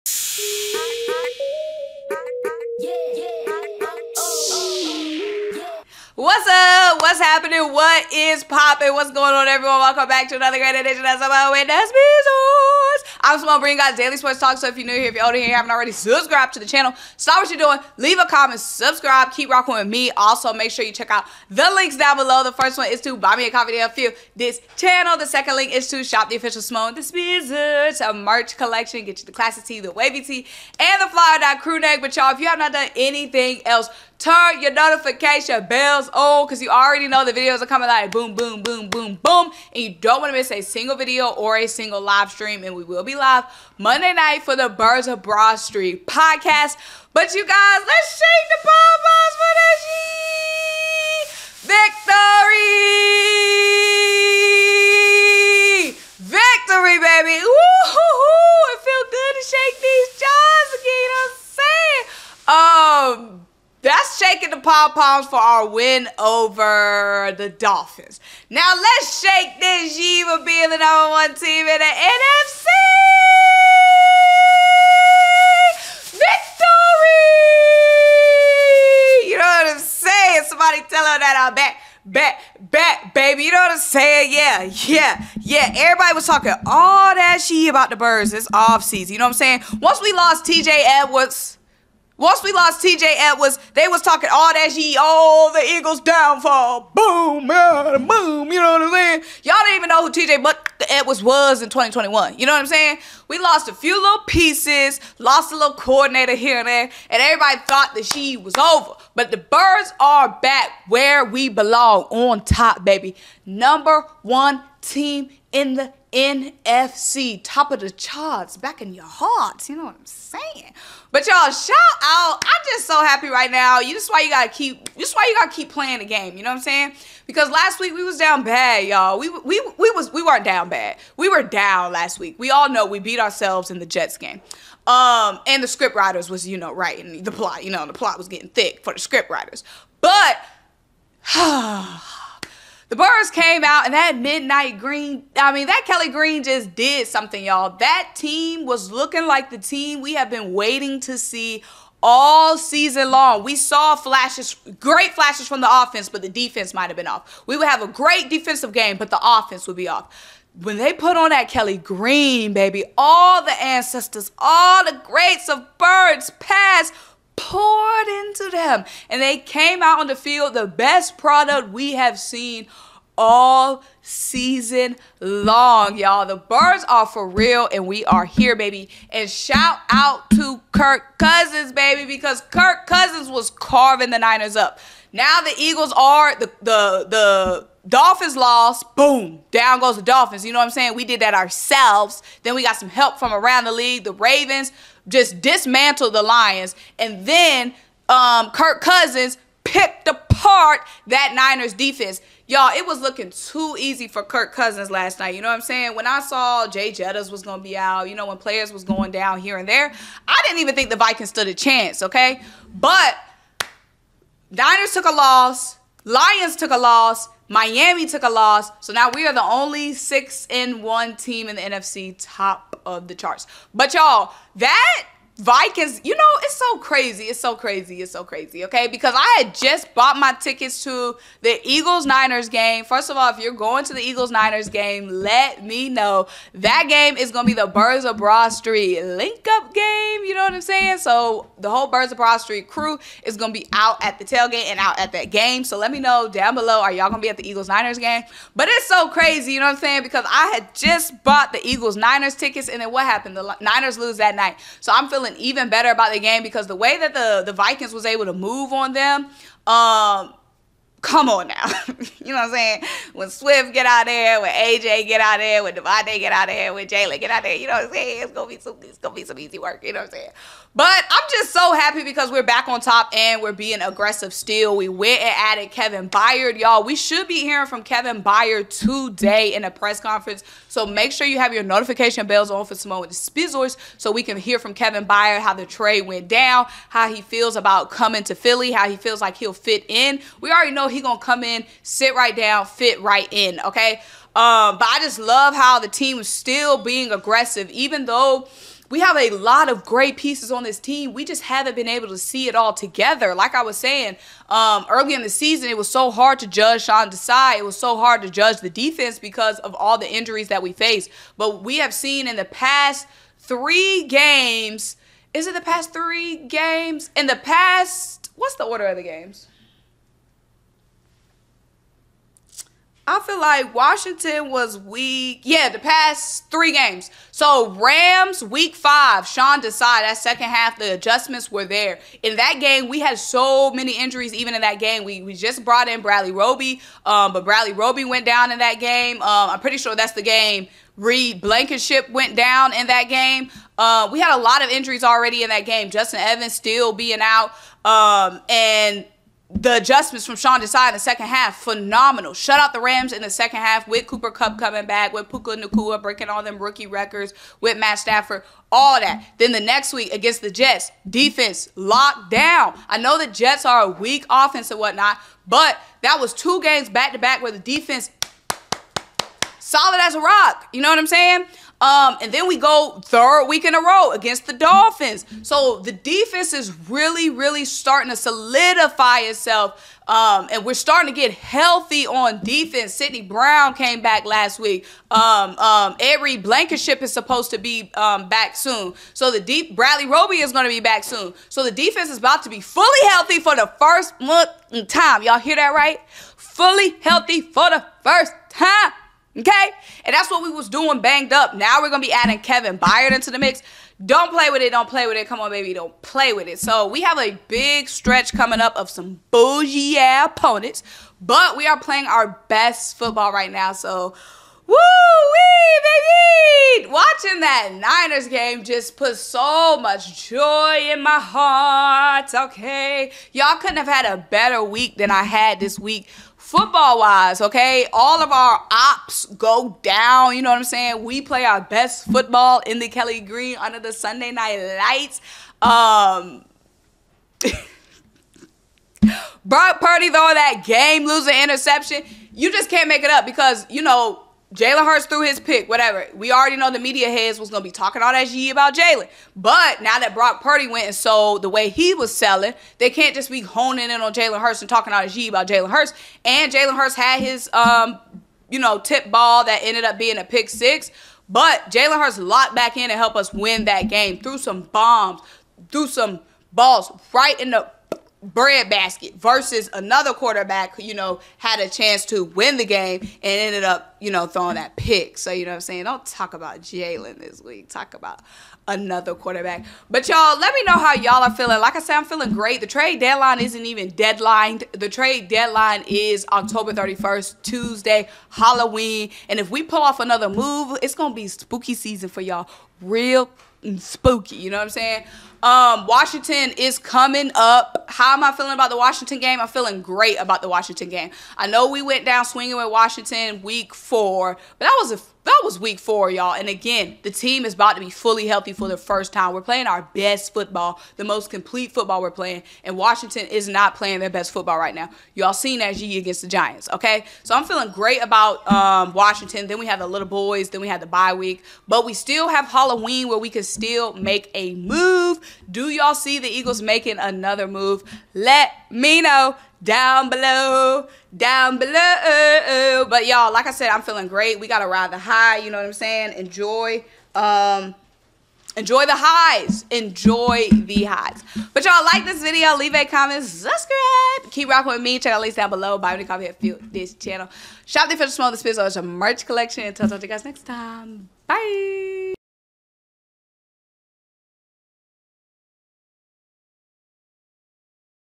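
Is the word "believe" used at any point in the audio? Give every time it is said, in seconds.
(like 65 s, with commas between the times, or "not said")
not said.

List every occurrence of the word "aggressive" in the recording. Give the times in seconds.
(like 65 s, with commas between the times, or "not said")
273 s, 297 s.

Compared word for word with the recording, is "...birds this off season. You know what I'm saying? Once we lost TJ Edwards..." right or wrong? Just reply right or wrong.
right.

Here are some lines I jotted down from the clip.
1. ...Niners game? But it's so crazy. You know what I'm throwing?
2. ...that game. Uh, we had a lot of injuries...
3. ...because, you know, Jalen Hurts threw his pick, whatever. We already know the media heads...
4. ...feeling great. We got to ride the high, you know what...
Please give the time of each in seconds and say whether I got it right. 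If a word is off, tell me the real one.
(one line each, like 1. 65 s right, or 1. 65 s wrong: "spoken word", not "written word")
1. 247 s wrong: "saying", not "throwing"
2. 342 s right
3. 443 s right
4. 533 s right.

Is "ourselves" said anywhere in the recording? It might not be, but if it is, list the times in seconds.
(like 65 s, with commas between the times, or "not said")
133 s, 191 s.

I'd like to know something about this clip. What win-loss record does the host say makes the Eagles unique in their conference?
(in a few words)
6-1.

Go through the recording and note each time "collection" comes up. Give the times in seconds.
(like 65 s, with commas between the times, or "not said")
28 s, 549 s.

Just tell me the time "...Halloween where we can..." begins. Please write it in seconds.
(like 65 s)
522 s.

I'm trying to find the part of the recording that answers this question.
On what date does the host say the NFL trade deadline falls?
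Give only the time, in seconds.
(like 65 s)
486 s.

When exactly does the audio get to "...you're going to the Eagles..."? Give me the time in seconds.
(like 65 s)
233 s.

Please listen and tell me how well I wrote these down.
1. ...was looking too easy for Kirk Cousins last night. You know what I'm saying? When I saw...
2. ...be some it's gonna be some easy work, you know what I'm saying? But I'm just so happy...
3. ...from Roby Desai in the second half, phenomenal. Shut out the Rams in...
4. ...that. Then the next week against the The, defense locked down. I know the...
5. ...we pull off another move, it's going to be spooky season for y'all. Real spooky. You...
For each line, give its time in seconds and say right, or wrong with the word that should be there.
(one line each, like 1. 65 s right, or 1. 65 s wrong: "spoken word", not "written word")
1. 202 s right
2. 268 s right
3. 350 s wrong: "Sean", not "Roby"
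4. 358 s wrong: "Jets", not "The"
5. 489 s right.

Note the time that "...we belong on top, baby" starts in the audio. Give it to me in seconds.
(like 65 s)
111 s.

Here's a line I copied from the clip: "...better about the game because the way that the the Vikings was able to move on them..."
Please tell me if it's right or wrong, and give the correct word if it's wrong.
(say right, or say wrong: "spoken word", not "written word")
right.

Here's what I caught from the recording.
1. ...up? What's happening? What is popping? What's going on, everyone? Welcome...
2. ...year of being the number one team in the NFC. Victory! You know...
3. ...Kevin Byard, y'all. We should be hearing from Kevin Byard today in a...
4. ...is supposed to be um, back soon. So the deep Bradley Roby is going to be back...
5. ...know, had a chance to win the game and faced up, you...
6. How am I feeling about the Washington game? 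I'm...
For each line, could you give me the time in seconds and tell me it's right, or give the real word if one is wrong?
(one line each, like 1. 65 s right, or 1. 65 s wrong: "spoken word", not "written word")
1. 6 s right
2. 69 s right
3. 275 s right
4. 387 s right
5. 470 s wrong: "ended", not "faced"
6. 497 s right.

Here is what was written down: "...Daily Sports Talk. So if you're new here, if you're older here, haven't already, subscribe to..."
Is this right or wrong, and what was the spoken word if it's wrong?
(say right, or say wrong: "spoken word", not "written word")
right.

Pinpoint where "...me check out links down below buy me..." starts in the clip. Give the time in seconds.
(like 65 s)
544 s.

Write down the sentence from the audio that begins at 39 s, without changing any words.
And you don't want to miss a single video or a single live stream.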